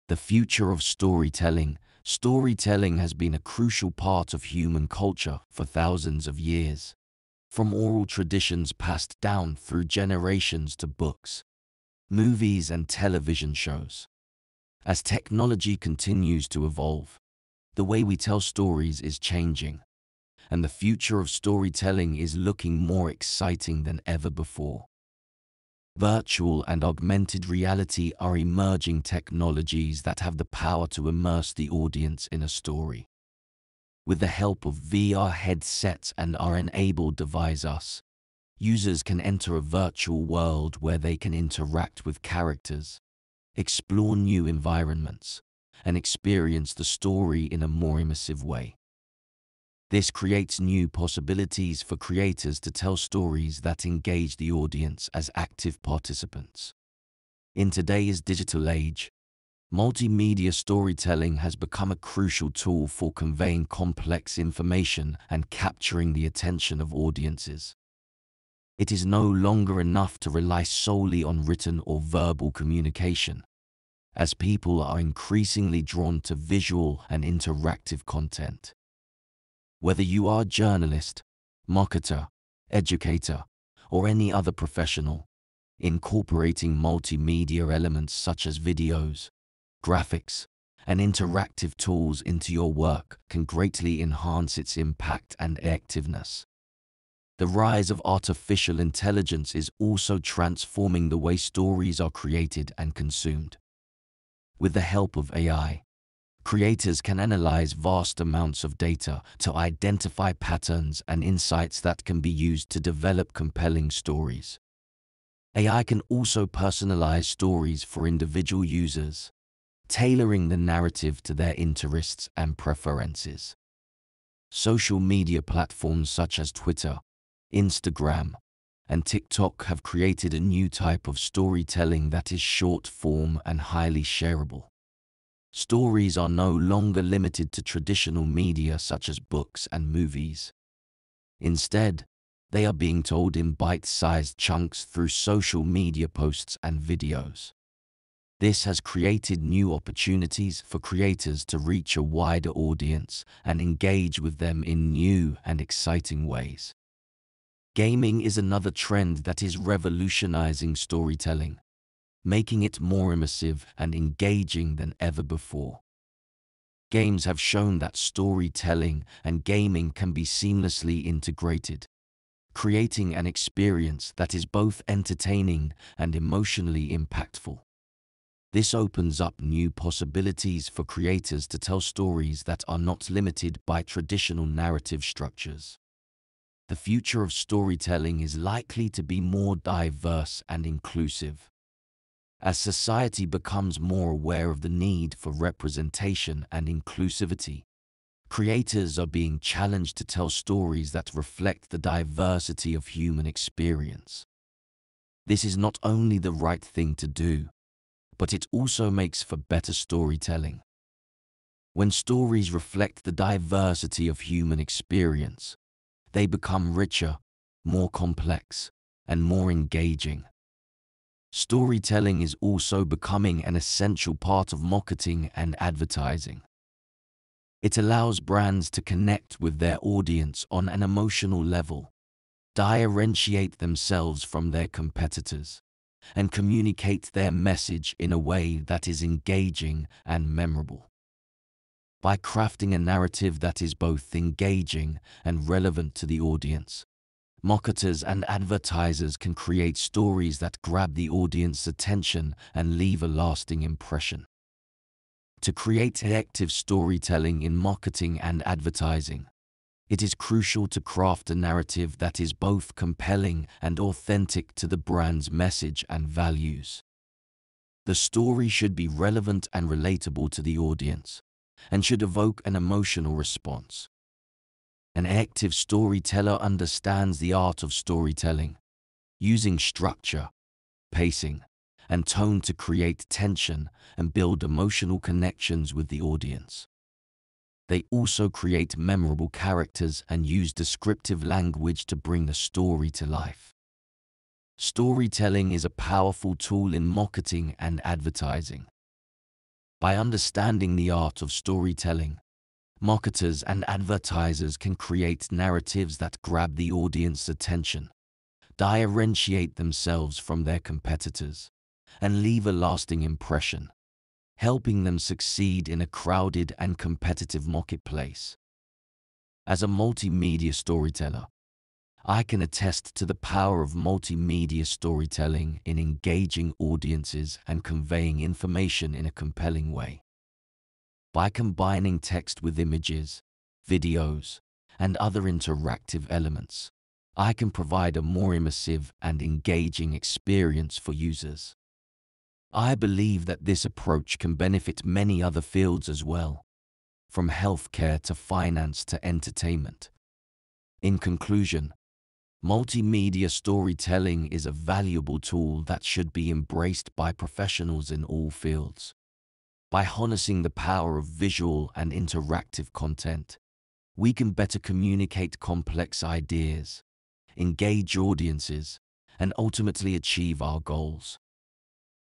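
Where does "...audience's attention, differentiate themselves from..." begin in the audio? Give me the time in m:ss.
5:06.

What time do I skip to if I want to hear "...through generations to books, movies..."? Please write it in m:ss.
0:09.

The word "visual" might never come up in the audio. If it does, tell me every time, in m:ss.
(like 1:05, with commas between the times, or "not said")
1:16, 6:01.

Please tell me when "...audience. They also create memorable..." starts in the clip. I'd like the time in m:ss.
4:46.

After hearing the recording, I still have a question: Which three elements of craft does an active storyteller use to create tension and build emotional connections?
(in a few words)
Structure, pacing, and tone.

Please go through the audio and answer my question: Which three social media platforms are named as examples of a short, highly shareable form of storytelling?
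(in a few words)
Twitter, Instagram, and TikTok.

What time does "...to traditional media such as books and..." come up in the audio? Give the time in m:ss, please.
2:17.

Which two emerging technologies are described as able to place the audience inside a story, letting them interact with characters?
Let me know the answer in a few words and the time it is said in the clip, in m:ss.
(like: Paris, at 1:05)
Virtual and augmented reality, at 0:26.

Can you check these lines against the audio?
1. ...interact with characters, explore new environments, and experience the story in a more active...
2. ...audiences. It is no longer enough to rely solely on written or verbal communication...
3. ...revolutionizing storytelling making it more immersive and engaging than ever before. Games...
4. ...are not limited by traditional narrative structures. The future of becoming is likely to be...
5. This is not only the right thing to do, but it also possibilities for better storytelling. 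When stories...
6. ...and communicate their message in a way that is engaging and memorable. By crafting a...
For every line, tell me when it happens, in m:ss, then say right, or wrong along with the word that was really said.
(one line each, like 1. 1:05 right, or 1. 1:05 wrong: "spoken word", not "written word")
1. 0:41 wrong: "immersive", not "active"
2. 1:06 right
3. 2:39 right
4. 3:02 wrong: "storytelling", not "becoming"
5. 3:25 wrong: "makes", not "possibilities"
6. 3:56 right.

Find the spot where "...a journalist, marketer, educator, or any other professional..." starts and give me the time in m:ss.
1:20.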